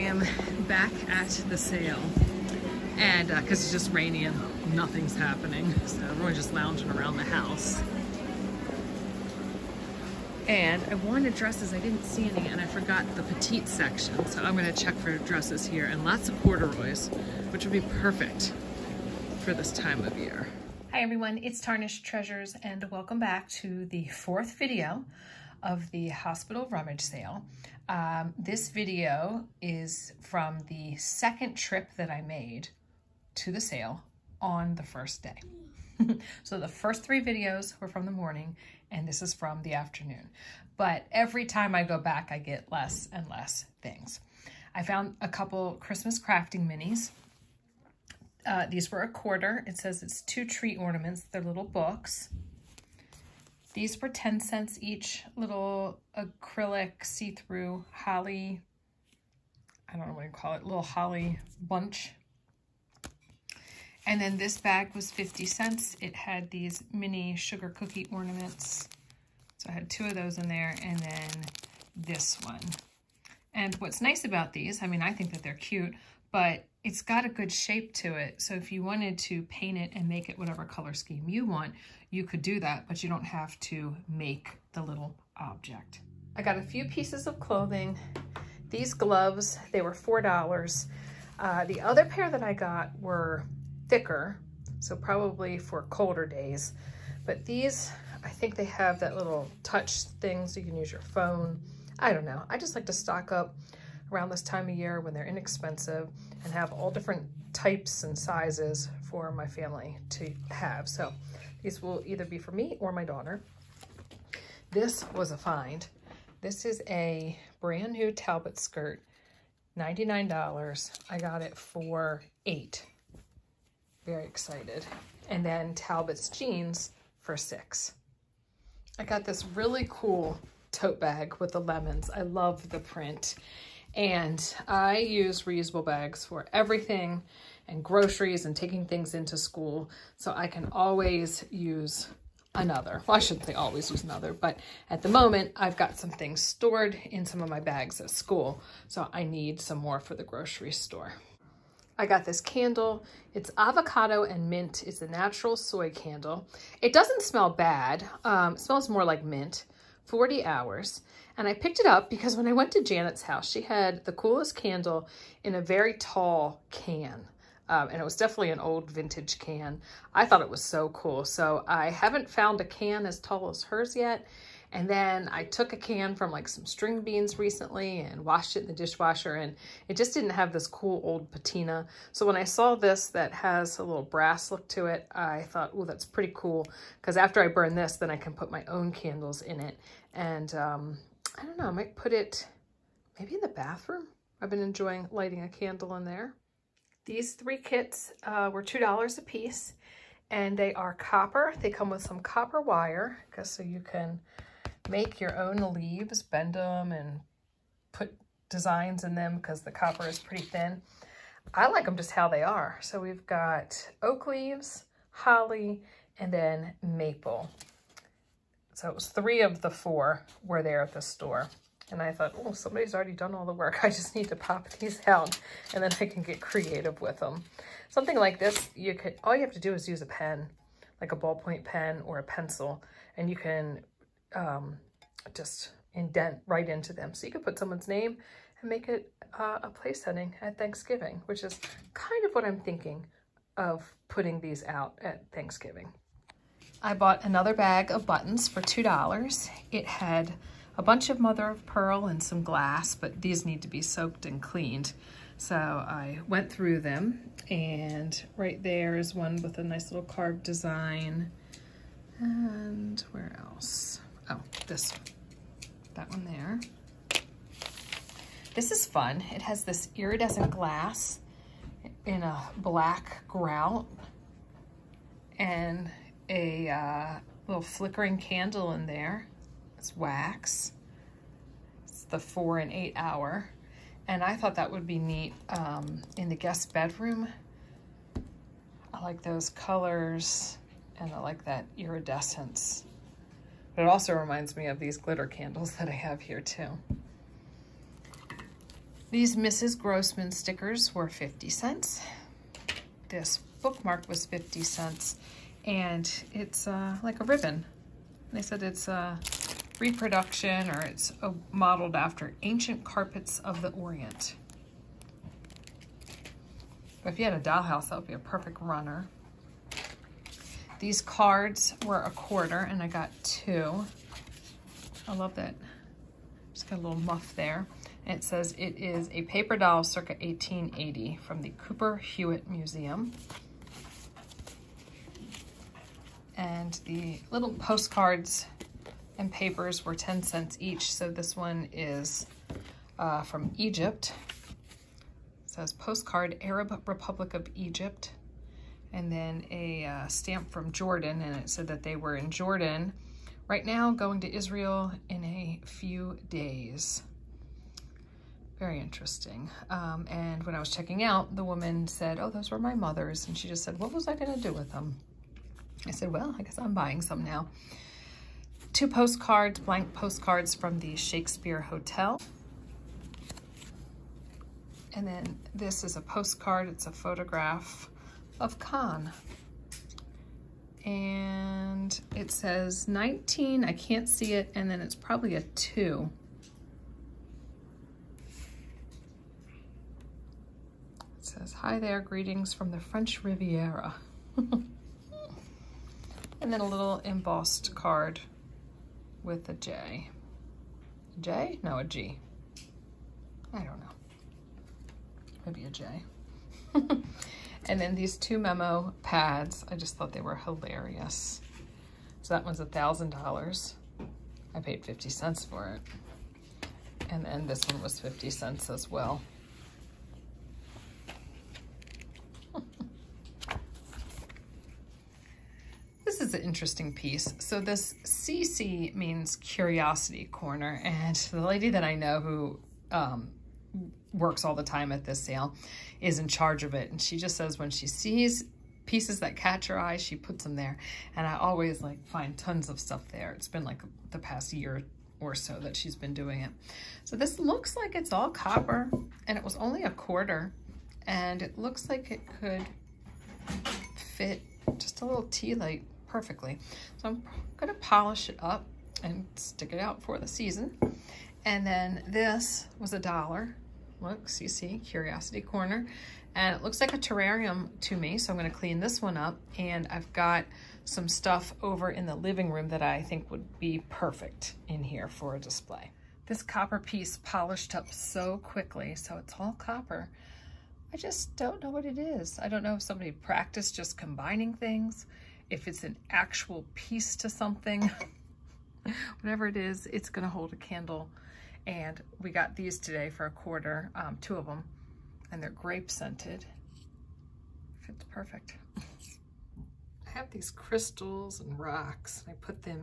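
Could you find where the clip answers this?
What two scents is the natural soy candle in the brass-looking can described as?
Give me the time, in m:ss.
2:33.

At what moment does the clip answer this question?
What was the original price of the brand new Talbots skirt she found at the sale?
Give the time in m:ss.
1:59.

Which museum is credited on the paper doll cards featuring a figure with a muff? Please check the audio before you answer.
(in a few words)
Cooper Hewitt Museum.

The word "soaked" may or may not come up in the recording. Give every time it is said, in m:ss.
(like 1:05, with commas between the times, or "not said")
4:13.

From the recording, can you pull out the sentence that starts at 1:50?
So these will either be for me or my daughter.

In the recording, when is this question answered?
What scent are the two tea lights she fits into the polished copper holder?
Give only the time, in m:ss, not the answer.
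8:15.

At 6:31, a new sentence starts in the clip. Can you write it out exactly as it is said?
It says, hi there, greetings from the French Riviera.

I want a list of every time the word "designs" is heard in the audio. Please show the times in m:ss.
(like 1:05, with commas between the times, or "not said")
3:28, 4:20.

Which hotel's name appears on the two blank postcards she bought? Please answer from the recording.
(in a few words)
Shakespeare Hotel.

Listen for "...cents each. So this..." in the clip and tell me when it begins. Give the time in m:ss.
5:40.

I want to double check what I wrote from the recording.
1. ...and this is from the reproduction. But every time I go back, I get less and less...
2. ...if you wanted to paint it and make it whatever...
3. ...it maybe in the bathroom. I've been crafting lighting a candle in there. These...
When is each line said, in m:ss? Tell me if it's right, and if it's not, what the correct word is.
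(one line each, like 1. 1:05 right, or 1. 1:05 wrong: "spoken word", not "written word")
1. 0:38 wrong: "afternoon", not "reproduction"
2. 1:18 right
3. 3:12 wrong: "enjoying", not "crafting".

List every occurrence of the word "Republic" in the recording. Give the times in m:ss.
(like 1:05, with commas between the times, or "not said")
5:46.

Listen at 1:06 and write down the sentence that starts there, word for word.
It had these mini sugar cookie ornaments.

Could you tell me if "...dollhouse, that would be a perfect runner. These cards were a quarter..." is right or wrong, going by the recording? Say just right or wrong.
right.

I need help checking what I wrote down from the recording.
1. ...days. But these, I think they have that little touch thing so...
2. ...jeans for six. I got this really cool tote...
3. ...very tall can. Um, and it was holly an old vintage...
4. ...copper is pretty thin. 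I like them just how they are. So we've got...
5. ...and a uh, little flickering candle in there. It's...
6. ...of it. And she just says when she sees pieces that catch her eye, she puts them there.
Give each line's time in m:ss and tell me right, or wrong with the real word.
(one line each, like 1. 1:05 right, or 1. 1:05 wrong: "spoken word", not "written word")
1. 1:36 right
2. 2:06 right
3. 2:45 wrong: "definitely", not "holly"
4. 3:29 right
5. 4:35 right
6. 7:16 right.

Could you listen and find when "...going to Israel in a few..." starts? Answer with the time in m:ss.
5:53.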